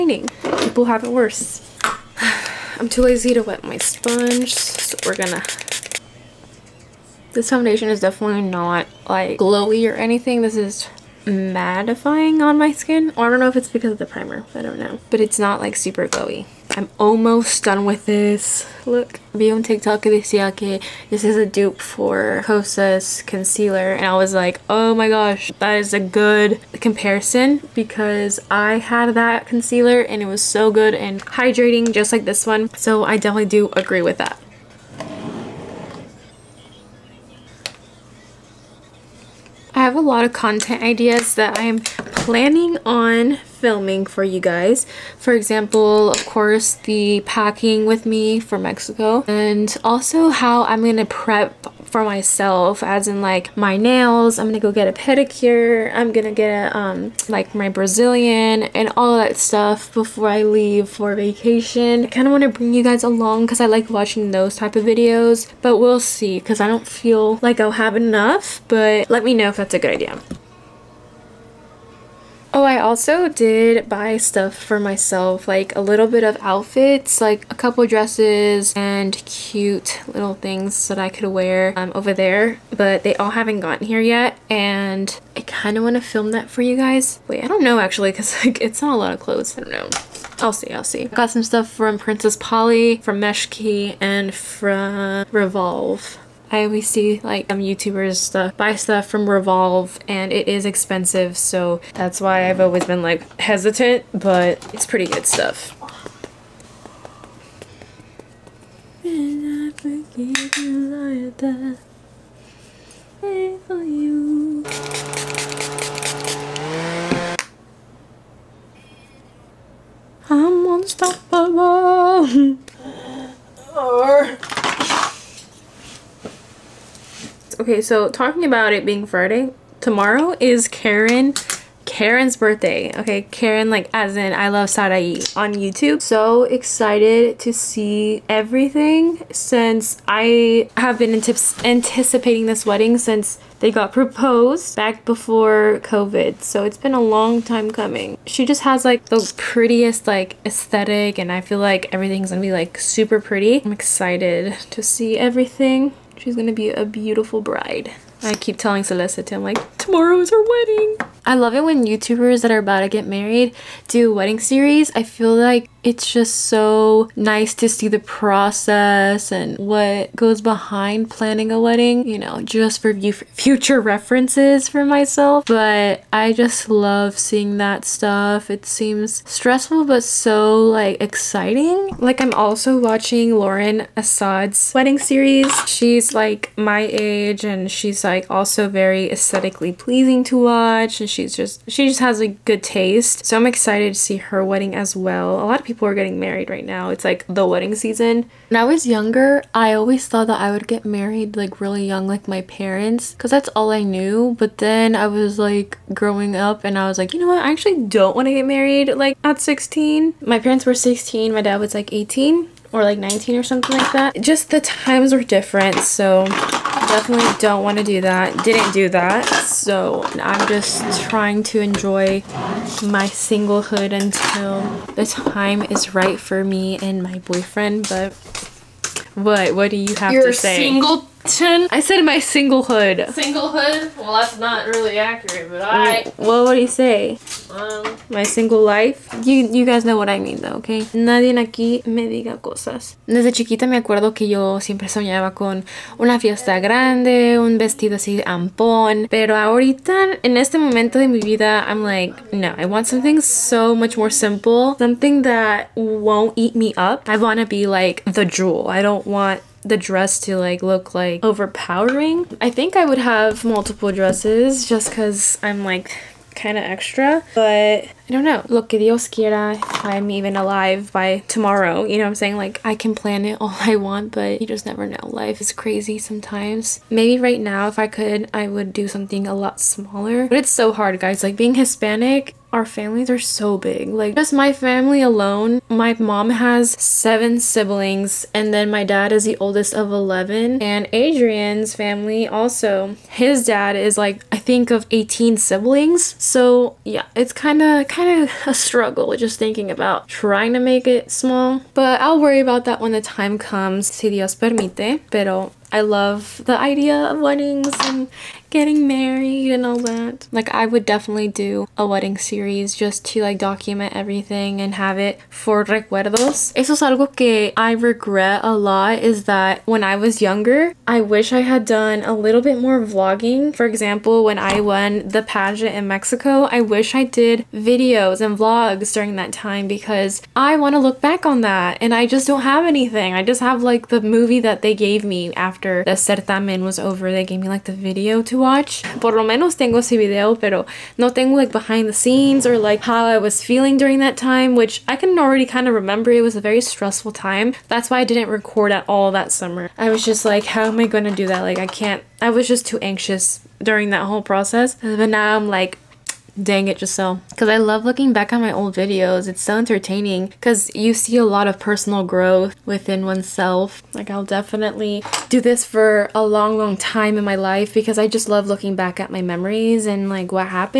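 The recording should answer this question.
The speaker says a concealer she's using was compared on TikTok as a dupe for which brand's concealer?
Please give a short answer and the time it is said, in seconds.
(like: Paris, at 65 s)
Kosas, at 22 s.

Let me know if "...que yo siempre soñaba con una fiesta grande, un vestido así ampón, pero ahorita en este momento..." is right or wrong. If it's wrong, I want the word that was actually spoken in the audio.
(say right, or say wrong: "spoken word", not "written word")
right.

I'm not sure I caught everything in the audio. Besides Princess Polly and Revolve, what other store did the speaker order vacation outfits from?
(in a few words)
Meshki.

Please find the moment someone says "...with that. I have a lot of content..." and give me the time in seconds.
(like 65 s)
34 s.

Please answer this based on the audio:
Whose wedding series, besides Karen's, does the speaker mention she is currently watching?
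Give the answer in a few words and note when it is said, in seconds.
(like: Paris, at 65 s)
Lauren Assad, at 183 s.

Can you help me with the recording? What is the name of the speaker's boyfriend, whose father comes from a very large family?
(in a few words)
Adrian.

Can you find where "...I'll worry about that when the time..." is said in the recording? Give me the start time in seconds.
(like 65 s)
301 s.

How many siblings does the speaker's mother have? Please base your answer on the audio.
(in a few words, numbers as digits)
7.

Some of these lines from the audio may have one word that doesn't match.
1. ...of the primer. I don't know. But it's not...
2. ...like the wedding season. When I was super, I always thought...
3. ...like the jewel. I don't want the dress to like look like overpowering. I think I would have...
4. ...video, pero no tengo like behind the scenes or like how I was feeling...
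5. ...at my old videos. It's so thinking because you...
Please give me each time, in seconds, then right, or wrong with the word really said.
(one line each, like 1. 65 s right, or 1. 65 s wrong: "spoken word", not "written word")
1. 13 s right
2. 197 s wrong: "younger", not "super"
3. 257 s right
4. 339 s right
5. 358 s wrong: "entertaining", not "thinking".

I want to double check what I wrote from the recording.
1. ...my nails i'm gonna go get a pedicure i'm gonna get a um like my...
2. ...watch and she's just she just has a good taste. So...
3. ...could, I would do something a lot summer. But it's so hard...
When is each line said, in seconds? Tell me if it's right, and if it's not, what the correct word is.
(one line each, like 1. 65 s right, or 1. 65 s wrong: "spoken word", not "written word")
1. 53 s right
2. 190 s right
3. 277 s wrong: "smaller", not "summer".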